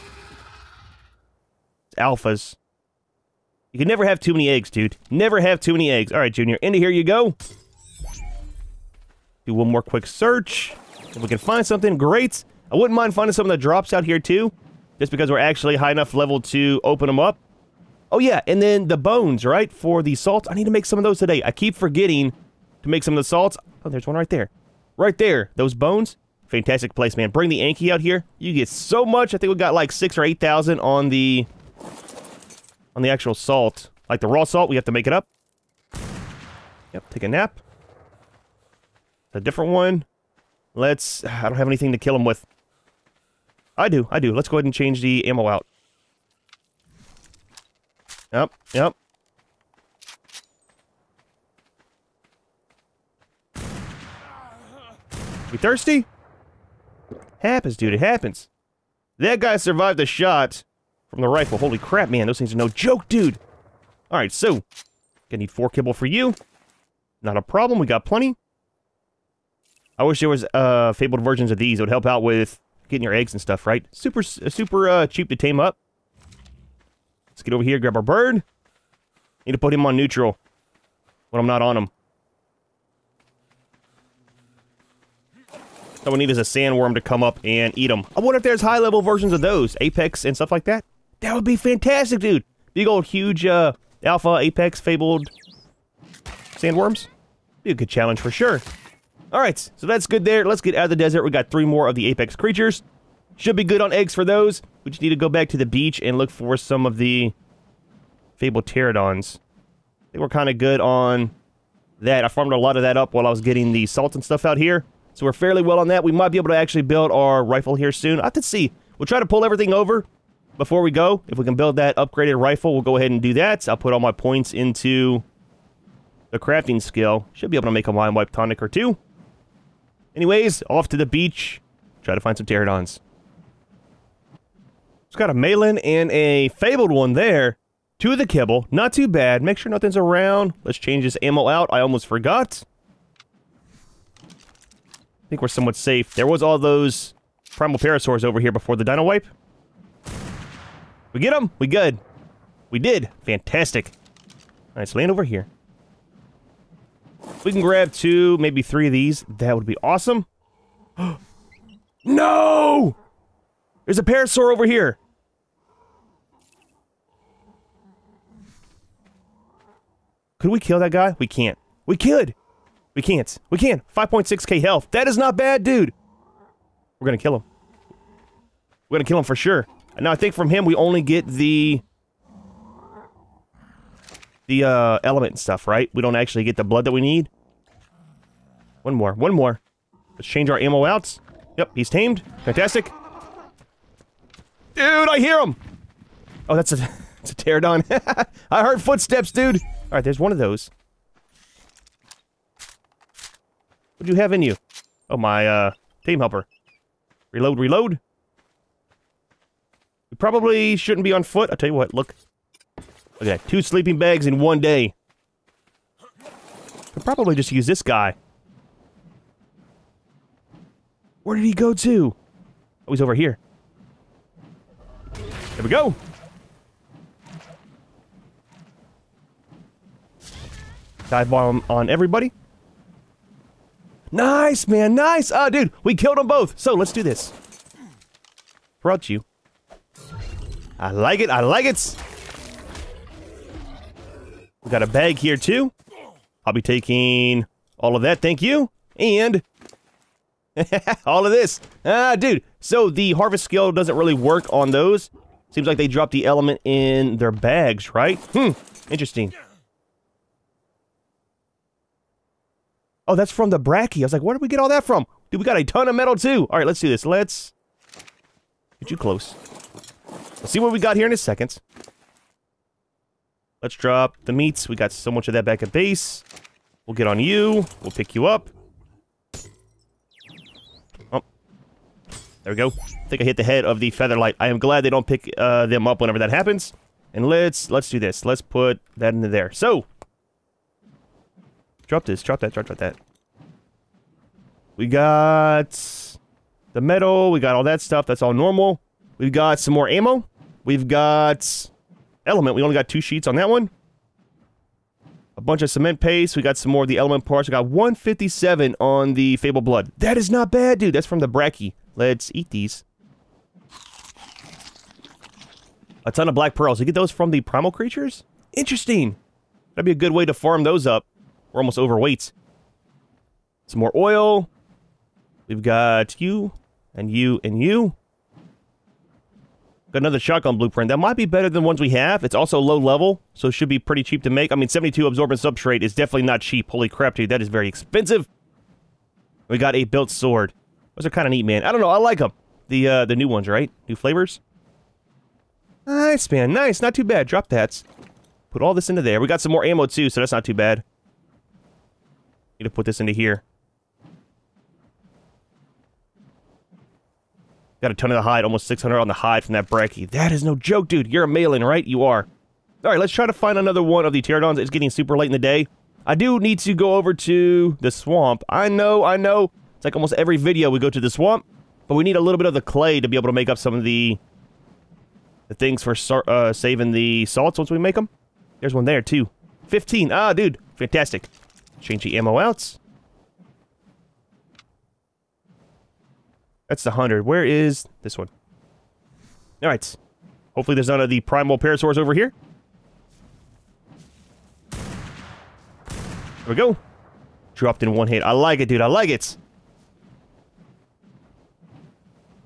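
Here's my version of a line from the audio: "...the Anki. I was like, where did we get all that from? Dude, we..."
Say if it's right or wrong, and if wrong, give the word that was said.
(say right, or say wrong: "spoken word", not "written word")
wrong: "Bracky", not "Anki".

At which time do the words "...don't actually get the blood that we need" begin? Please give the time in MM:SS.
03:06.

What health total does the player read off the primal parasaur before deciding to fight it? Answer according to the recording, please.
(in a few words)
5.6k.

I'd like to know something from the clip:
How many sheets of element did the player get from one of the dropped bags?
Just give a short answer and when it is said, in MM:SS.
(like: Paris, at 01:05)
2, at 05:02.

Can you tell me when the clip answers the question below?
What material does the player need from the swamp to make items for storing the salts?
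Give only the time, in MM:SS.
06:12.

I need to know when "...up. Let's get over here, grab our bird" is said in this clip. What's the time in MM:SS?
01:15.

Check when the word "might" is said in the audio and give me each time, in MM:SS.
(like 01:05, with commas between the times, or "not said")
01:56, 05:30.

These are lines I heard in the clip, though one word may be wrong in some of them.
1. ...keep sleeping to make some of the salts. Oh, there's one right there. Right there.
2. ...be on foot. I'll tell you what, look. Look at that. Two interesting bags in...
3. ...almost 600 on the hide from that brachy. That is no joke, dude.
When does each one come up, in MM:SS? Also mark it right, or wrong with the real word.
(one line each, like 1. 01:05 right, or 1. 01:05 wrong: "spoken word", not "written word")
1. 00:21 wrong: "forgetting", not "sleeping"
2. 03:31 wrong: "sleeping", not "interesting"
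3. 05:58 right.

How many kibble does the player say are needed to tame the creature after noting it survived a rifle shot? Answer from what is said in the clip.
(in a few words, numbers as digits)
4.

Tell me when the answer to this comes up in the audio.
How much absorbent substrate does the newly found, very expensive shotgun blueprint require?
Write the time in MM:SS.
05:34.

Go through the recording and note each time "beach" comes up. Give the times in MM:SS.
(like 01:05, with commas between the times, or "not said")
01:45, 02:11.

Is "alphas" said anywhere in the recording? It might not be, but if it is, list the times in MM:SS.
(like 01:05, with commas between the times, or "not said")
00:01, 01:34.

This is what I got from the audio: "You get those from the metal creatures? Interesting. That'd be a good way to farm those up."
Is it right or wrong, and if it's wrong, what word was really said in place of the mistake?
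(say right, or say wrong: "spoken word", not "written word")
wrong: "primal", not "metal".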